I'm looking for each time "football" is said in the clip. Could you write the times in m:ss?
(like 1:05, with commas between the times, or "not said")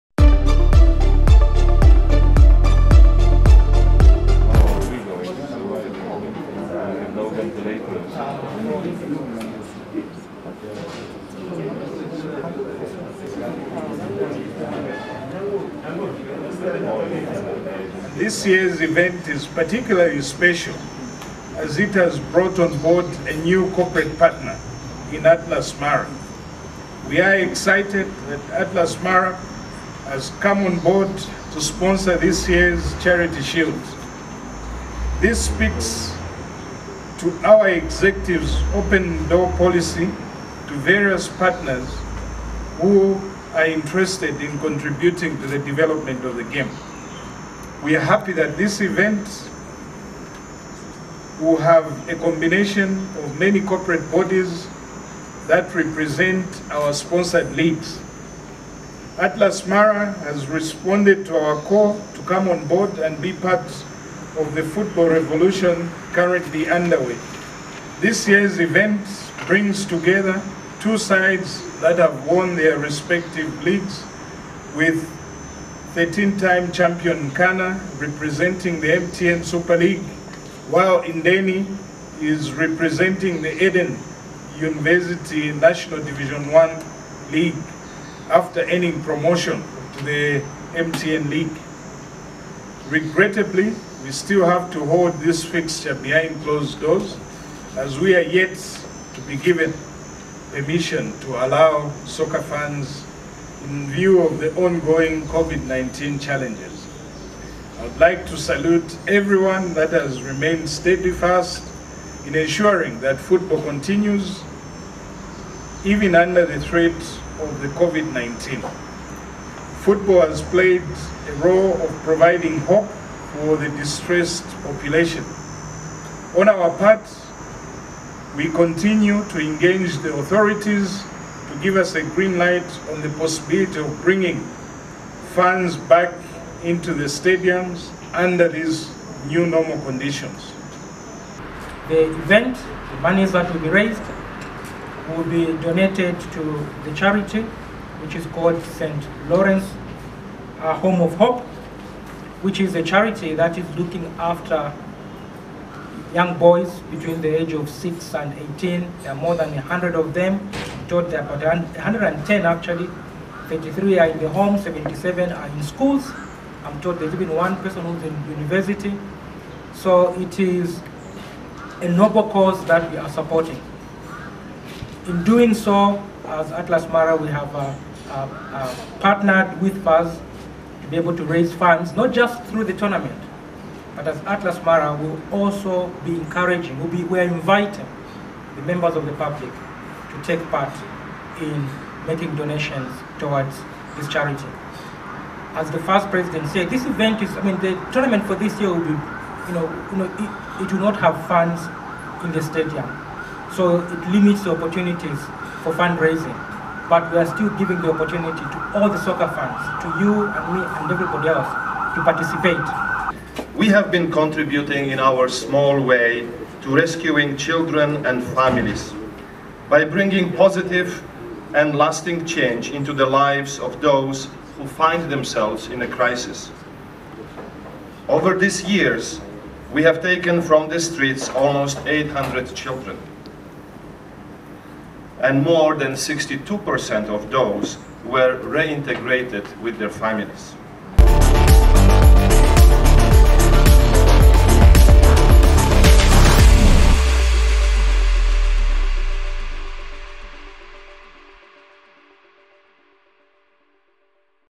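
1:04, 1:53, 1:59.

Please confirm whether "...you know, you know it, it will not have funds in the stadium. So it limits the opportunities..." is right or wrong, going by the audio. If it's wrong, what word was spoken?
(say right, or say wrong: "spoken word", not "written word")
right.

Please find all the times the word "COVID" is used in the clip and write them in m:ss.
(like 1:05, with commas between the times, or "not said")
1:45, 1:57.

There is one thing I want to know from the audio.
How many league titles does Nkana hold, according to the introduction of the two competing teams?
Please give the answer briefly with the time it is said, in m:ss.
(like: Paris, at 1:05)
13, at 1:15.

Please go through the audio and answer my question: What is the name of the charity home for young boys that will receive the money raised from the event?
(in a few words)
St. Lawrence a Home of Hope.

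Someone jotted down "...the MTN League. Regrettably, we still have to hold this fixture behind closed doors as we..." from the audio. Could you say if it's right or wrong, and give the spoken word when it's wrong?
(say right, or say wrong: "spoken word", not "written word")
right.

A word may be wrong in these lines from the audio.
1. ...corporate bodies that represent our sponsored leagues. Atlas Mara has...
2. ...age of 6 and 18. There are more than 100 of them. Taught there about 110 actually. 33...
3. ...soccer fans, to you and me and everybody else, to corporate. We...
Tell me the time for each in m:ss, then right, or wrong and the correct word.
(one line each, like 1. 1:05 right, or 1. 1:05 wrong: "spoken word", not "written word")
1. 0:53 right
2. 2:37 right
3. 3:29 wrong: "participate", not "corporate".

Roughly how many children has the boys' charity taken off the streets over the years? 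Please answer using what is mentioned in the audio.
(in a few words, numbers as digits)
800.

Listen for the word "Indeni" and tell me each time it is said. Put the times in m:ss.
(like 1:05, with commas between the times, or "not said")
1:21.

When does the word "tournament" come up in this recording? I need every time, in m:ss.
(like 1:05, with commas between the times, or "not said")
3:02, 3:17.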